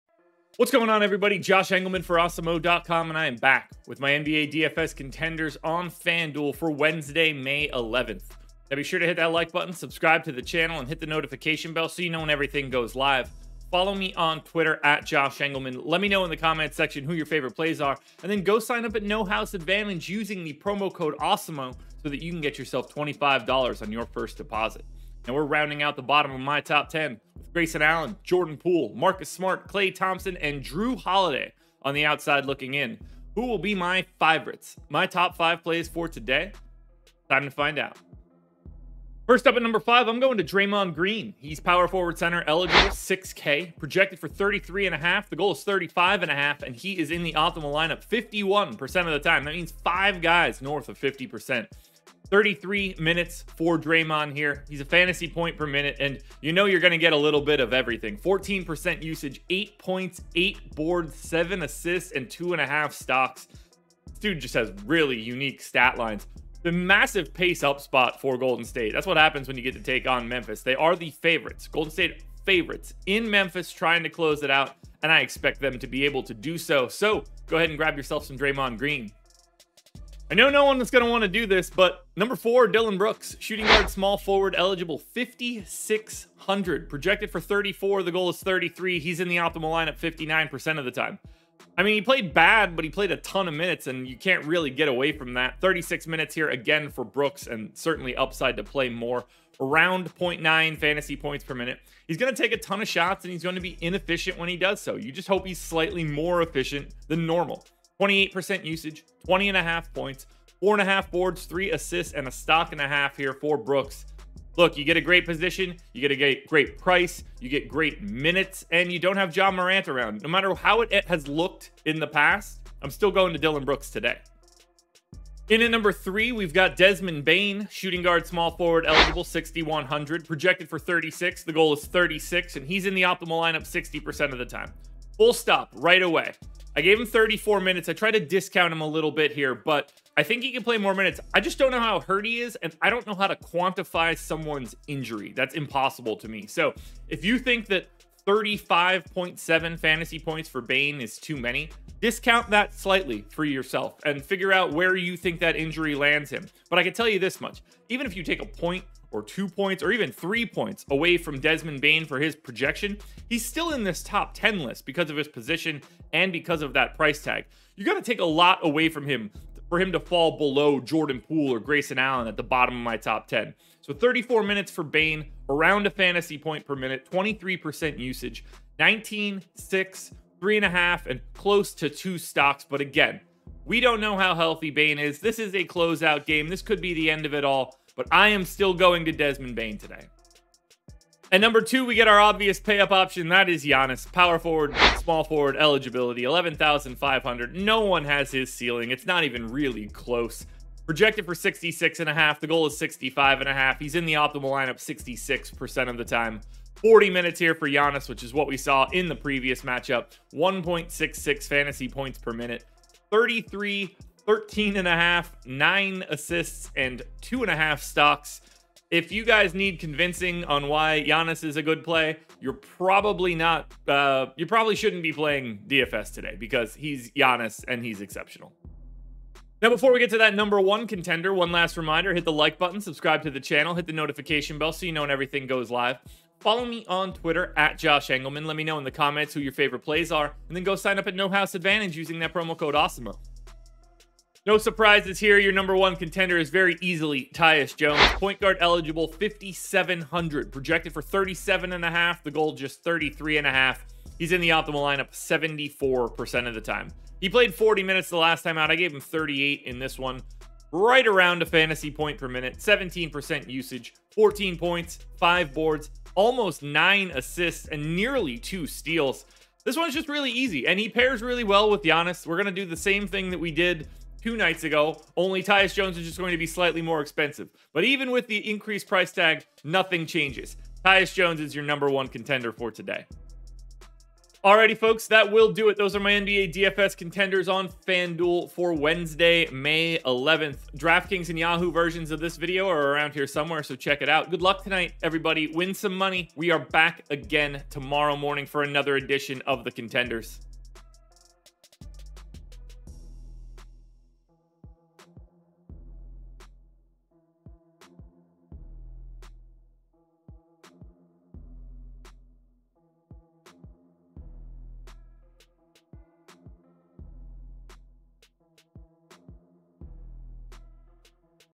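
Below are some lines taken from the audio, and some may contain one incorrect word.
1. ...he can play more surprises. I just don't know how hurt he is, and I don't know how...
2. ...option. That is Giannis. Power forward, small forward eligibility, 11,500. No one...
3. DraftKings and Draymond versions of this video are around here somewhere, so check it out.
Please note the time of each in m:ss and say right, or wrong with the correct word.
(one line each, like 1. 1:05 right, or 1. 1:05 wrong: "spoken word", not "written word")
1. 2:20 wrong: "minutes", not "surprises"
2. 3:12 right
3. 4:50 wrong: "Yahoo", not "Draymond".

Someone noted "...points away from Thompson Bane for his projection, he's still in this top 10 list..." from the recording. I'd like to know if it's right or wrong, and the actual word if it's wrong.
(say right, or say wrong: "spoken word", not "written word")
wrong: "Desmond", not "Thompson".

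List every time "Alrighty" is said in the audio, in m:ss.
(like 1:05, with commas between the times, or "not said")
4:44.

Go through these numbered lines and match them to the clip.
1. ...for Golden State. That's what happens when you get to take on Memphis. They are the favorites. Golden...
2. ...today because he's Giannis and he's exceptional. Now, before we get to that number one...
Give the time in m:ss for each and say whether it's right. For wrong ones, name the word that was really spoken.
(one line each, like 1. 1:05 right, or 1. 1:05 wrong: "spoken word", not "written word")
1. 1:08 right
2. 3:46 right.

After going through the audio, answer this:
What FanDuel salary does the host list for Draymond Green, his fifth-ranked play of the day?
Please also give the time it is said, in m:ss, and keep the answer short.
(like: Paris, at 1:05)
6K, at 0:42.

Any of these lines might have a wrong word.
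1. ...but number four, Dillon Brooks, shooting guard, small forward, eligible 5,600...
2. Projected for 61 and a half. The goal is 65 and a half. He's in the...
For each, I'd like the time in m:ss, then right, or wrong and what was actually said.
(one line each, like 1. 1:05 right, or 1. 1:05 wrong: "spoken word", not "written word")
1. 1:21 right
2. 3:20 wrong: "66", not "61".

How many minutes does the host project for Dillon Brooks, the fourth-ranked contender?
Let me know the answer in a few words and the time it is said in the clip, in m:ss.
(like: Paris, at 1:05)
36, at 1:35.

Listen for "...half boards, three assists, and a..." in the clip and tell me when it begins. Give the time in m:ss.
1:50.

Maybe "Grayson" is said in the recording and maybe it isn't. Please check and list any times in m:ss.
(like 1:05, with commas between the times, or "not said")
0:27, 2:51.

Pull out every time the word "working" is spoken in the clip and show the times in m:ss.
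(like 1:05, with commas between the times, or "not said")
not said.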